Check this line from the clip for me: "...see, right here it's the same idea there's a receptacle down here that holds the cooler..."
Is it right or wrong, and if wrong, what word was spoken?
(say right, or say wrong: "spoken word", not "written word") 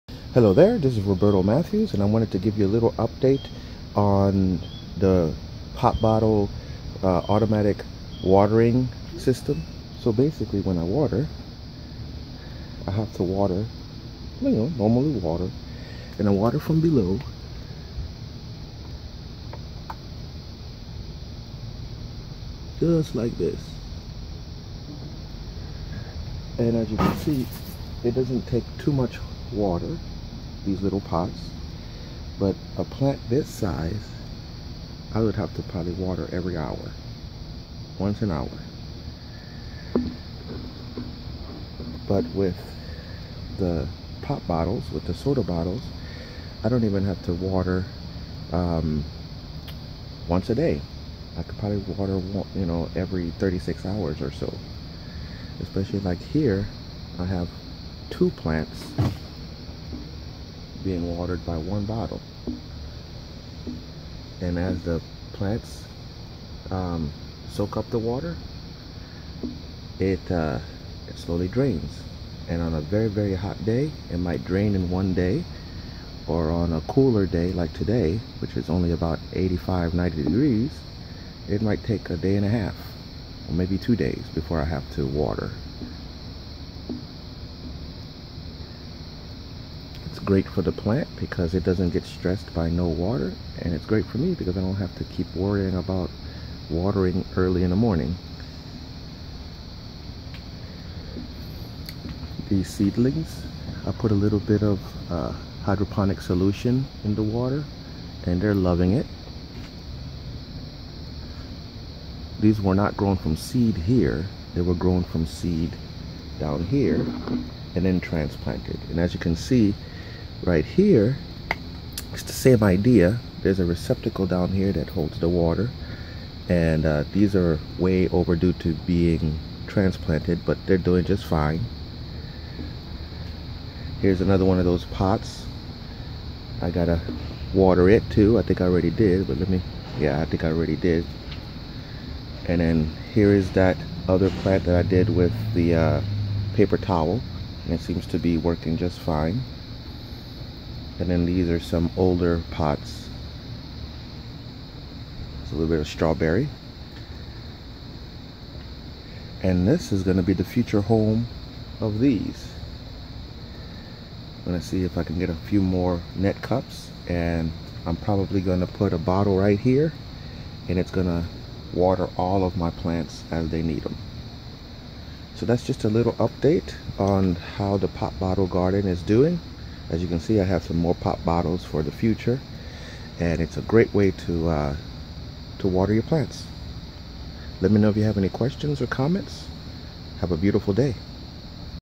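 wrong: "water", not "cooler".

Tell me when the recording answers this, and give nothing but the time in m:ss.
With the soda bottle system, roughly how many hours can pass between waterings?
0:53.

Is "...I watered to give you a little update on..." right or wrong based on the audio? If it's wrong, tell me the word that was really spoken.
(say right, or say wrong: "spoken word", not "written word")
wrong: "wanted", not "watered".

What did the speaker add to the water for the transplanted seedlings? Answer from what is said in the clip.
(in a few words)
Hydroponic solution.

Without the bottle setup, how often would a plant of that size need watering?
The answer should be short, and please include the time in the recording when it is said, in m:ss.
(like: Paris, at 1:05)
Once an hour, at 0:37.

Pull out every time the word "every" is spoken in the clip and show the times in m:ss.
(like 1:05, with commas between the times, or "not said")
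0:36, 0:52.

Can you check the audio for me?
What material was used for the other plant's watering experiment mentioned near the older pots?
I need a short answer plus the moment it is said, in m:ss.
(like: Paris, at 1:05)
Paper towel, at 2:26.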